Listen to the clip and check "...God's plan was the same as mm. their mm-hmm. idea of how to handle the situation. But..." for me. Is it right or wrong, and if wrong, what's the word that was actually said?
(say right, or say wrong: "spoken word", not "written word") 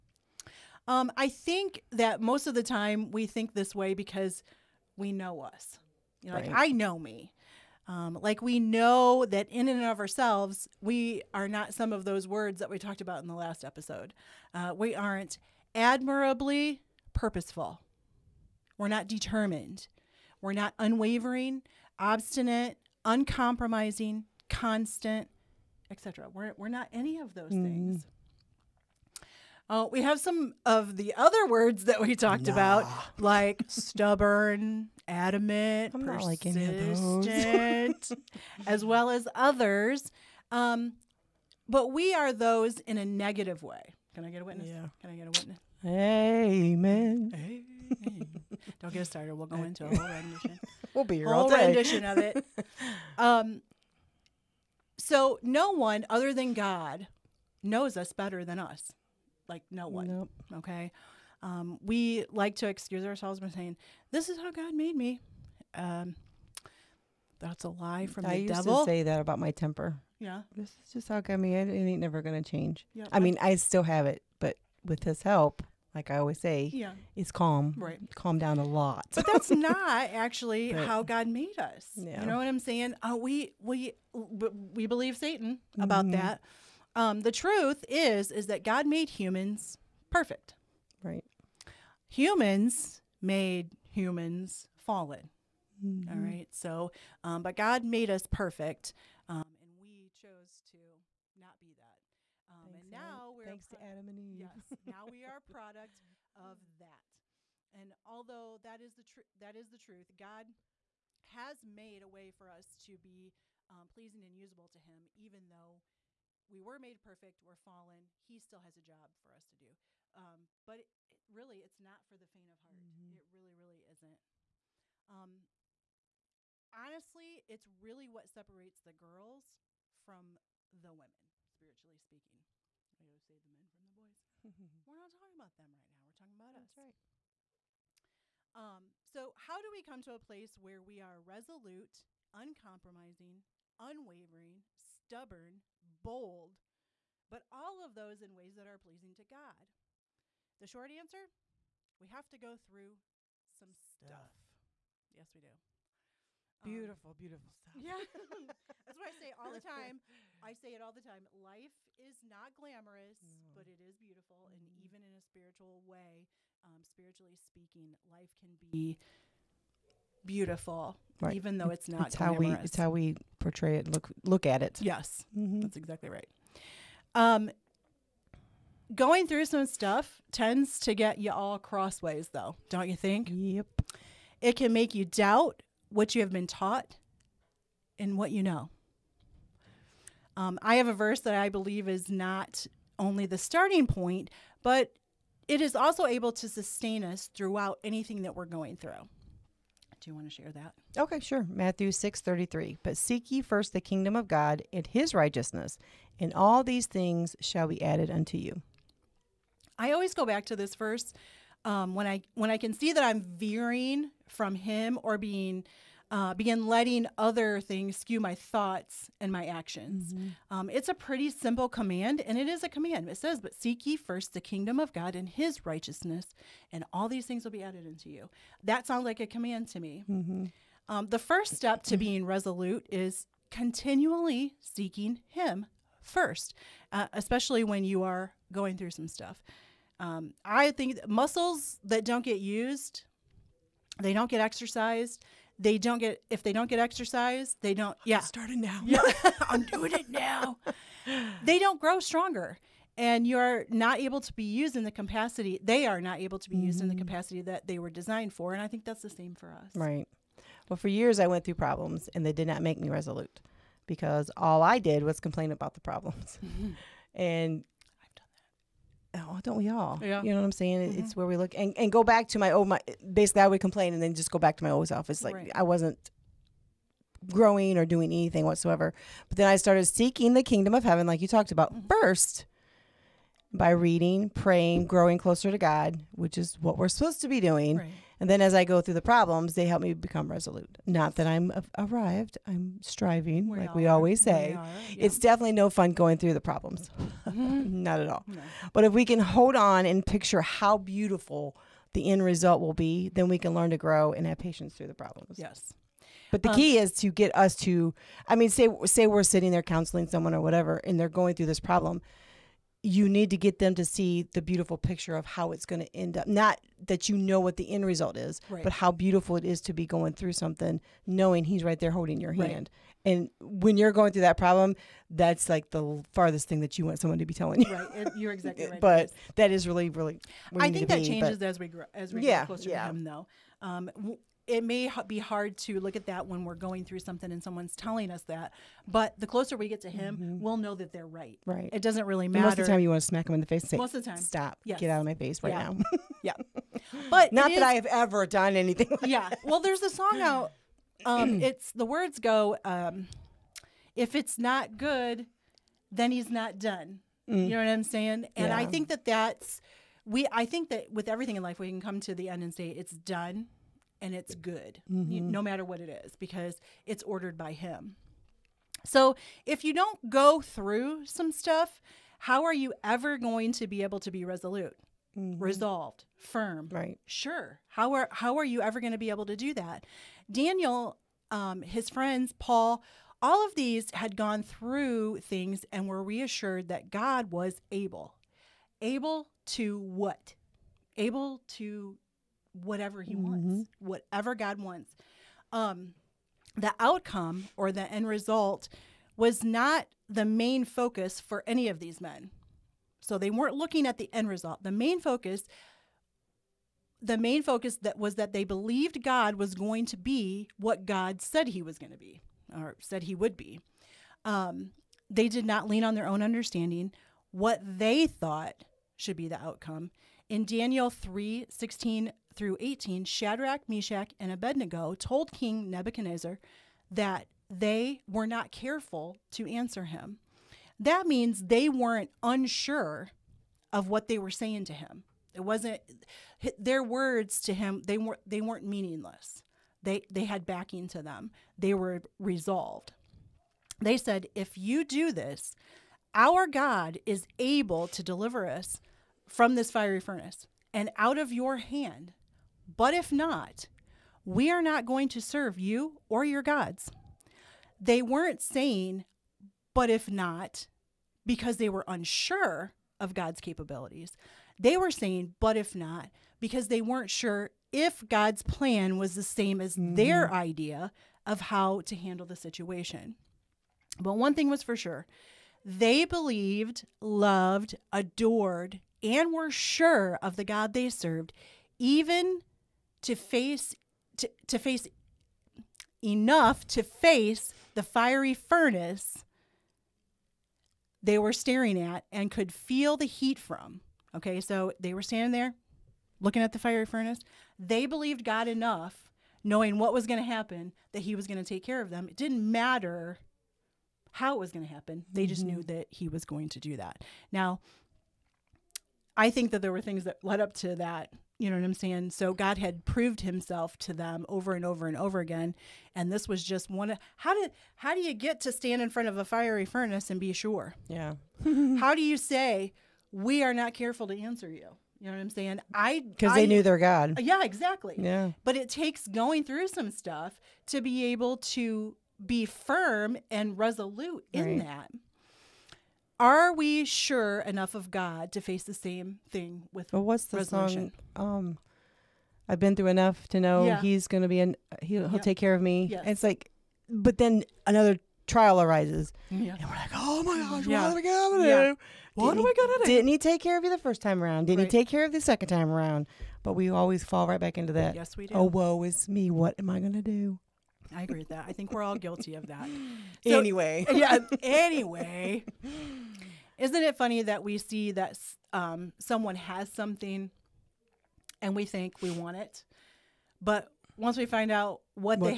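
right.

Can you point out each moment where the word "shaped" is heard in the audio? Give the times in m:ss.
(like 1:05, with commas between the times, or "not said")
not said.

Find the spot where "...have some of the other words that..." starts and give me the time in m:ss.
0:30.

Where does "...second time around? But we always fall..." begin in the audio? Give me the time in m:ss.
9:15.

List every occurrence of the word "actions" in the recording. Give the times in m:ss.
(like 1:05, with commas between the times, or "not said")
3:39.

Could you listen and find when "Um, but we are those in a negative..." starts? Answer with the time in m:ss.
0:40.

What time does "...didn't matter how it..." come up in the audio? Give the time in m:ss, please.
8:22.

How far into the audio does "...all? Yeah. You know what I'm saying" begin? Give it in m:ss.
4:29.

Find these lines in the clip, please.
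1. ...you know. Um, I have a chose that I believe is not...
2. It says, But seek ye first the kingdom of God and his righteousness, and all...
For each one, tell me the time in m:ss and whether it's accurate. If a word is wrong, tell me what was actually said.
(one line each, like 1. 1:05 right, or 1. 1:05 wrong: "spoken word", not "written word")
1. 3:08 wrong: "verse", not "chose"
2. 3:43 right.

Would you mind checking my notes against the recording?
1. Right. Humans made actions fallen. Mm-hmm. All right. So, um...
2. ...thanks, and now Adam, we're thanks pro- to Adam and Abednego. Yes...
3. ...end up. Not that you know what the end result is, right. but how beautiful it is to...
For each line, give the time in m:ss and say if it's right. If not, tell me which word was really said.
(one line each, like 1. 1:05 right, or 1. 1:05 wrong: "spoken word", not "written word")
1. 1:31 wrong: "humans", not "actions"
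2. 1:42 wrong: "Eve", not "Abednego"
3. 5:15 right.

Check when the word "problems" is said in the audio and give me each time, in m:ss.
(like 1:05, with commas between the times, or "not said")
4:21, 4:25, 4:49, 4:56, 5:04, 5:11, 5:24.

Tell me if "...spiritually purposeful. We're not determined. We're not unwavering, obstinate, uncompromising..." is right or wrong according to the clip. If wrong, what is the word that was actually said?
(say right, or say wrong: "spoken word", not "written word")
wrong: "admirably", not "spiritually".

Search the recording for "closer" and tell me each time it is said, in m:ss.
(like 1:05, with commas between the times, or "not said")
4:45, 5:32, 5:39.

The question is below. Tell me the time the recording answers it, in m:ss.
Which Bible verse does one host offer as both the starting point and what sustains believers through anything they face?
3:21.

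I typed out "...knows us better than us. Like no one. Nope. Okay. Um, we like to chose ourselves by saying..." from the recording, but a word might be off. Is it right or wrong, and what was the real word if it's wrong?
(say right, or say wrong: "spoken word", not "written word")
wrong: "excuse", not "chose".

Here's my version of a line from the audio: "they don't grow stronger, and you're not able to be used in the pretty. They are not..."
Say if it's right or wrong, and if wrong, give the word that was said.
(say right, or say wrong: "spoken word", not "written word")
wrong: "capacity", not "pretty".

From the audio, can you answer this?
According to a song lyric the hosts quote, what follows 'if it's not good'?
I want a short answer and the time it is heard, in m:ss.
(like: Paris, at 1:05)
Then he's not done, at 5:55.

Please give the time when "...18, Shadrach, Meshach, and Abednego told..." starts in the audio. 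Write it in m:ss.
7:02.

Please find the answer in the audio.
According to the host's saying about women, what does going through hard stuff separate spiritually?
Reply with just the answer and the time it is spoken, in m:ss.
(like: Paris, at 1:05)
The girls from the women, at 2:08.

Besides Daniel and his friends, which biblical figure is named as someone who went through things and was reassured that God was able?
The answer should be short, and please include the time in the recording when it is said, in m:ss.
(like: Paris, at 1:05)
Paul, at 6:22.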